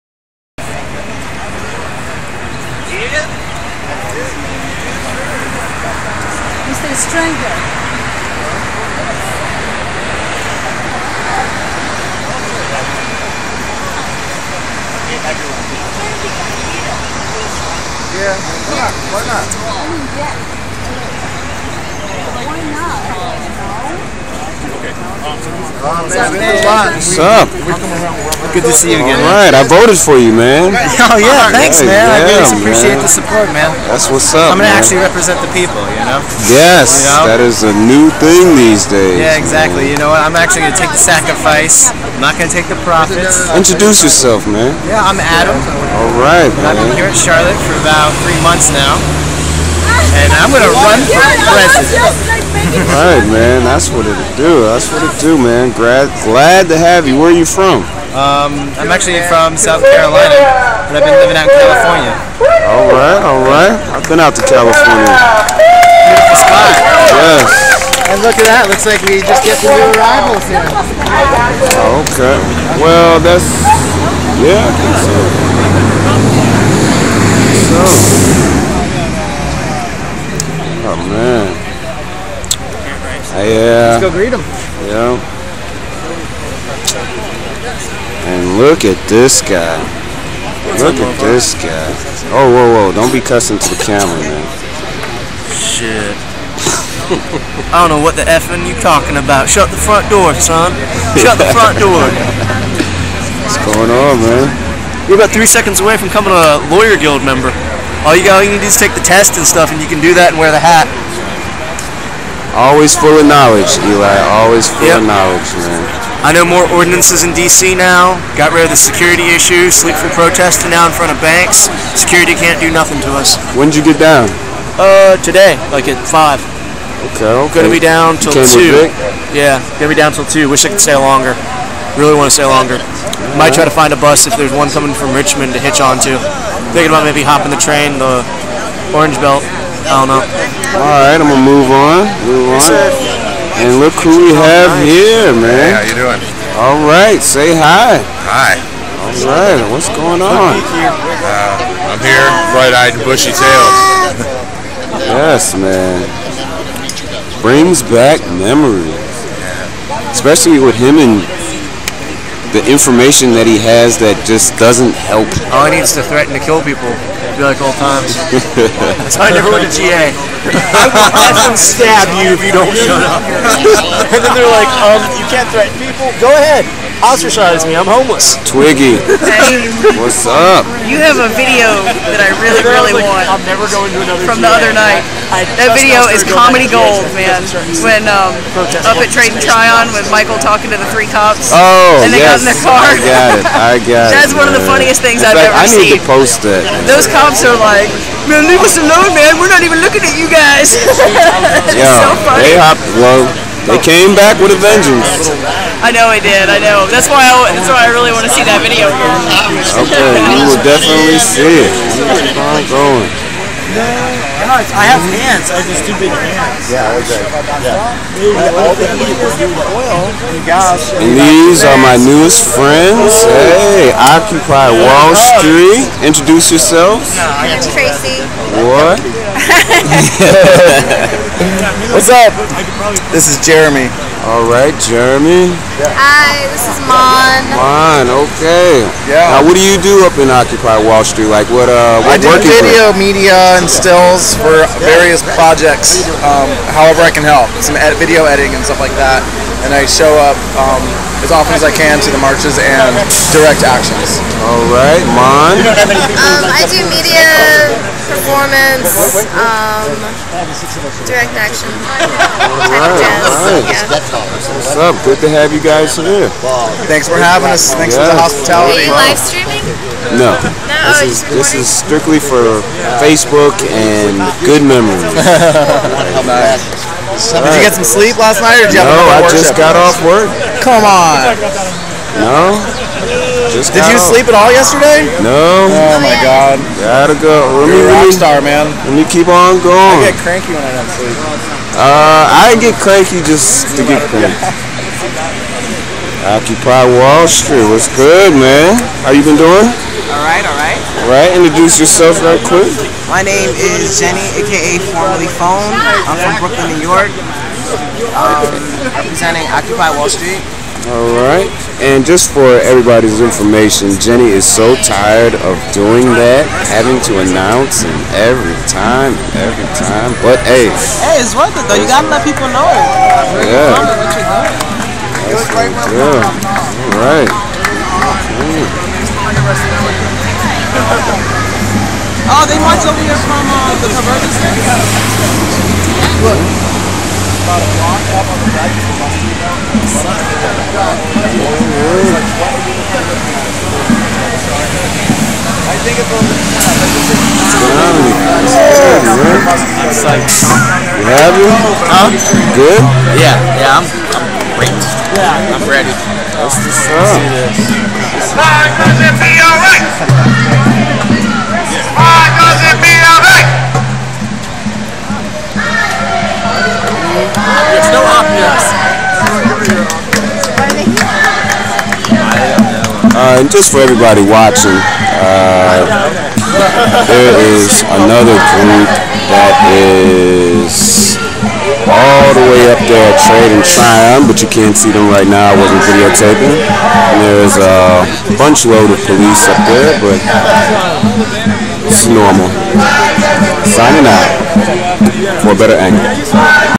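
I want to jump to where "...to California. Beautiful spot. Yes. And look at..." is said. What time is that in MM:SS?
01:04.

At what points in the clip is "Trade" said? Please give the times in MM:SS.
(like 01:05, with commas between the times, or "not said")
03:09, 06:23.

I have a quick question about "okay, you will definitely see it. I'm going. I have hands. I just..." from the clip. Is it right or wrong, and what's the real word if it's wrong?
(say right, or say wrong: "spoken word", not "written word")
right.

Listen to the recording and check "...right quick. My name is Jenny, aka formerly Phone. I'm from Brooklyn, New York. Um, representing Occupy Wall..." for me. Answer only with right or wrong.
right.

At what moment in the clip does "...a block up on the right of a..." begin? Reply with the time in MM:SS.
05:37.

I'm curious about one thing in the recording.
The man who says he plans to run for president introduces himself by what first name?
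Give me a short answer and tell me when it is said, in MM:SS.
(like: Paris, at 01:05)
Adam, at 00:45.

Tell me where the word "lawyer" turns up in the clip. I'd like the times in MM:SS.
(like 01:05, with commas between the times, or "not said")
01:46.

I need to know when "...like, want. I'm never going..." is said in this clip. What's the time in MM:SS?
03:02.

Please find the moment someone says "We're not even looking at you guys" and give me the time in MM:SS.
03:19.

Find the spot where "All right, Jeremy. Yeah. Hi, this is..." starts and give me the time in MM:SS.
03:54.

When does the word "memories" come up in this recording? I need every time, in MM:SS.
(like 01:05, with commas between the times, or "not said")
02:38, 04:34.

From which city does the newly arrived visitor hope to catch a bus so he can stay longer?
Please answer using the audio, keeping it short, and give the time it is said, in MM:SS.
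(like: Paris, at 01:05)
Richmond, at 02:15.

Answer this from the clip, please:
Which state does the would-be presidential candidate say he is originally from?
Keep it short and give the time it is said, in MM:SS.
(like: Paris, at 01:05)
South Carolina, at 00:59.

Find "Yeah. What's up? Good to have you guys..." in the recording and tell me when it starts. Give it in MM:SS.
04:23.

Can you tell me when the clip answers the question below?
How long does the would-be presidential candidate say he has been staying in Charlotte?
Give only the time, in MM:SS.
00:47.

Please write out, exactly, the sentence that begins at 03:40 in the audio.
And these are my newest friends.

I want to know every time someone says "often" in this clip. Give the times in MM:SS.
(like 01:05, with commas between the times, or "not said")
04:11.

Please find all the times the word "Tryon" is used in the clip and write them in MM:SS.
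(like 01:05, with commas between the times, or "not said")
03:09, 06:23.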